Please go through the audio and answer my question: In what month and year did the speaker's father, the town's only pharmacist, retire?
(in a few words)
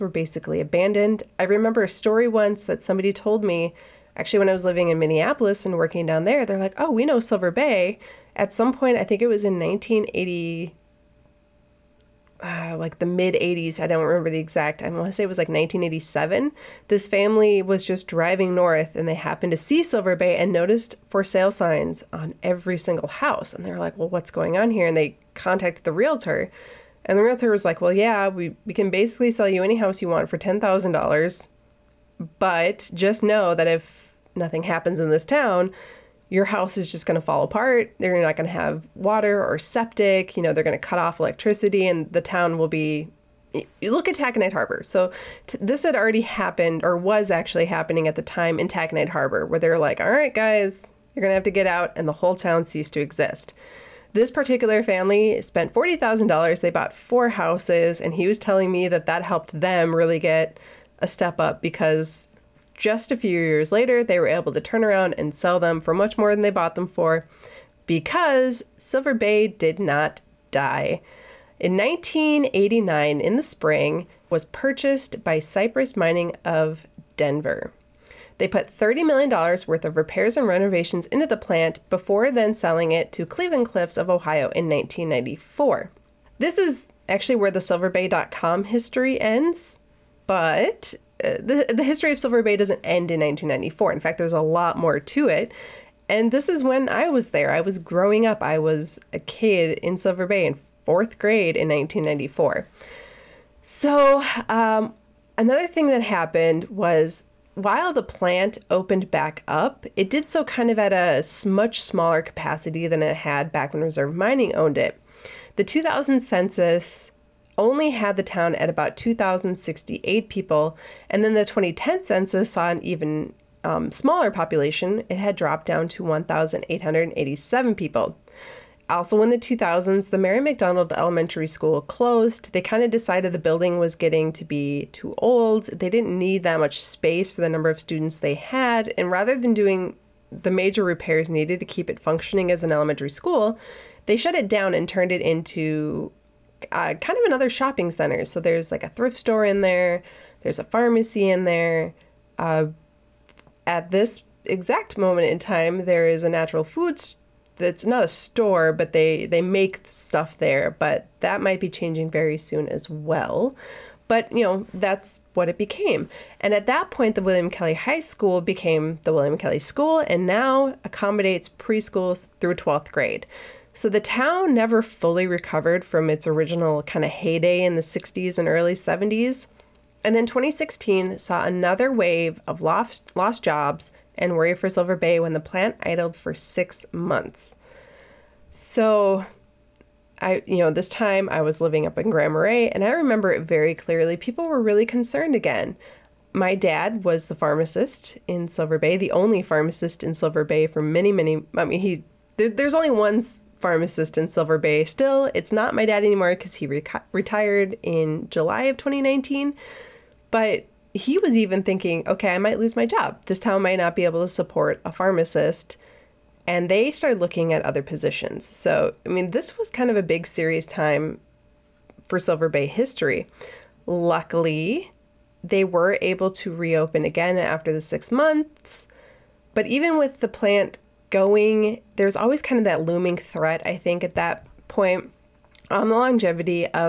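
July 2019.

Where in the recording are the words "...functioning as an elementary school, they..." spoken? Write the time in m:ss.
2:21.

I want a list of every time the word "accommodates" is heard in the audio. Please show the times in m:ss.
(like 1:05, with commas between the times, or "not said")
2:50.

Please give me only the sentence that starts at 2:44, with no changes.
But you know that's what it became.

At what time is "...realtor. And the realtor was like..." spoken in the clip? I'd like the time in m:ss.
0:25.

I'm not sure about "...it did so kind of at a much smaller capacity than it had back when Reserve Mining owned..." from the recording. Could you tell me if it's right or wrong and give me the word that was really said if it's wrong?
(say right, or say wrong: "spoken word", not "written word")
right.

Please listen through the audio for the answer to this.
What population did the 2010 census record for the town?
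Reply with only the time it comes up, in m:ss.
2:06.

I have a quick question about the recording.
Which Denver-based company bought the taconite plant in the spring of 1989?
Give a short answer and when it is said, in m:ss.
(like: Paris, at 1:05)
Cyprus Mining, at 1:15.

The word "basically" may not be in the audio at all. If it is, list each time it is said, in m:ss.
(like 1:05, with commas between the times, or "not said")
0:00, 0:28.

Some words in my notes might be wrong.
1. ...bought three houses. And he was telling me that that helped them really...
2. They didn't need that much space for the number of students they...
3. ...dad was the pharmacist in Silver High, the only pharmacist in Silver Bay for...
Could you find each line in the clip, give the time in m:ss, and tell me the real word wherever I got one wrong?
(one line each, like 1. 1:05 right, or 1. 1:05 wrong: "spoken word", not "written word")
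1. 0:56 wrong: "four", not "three"
2. 2:15 right
3. 3:16 wrong: "Bay", not "High".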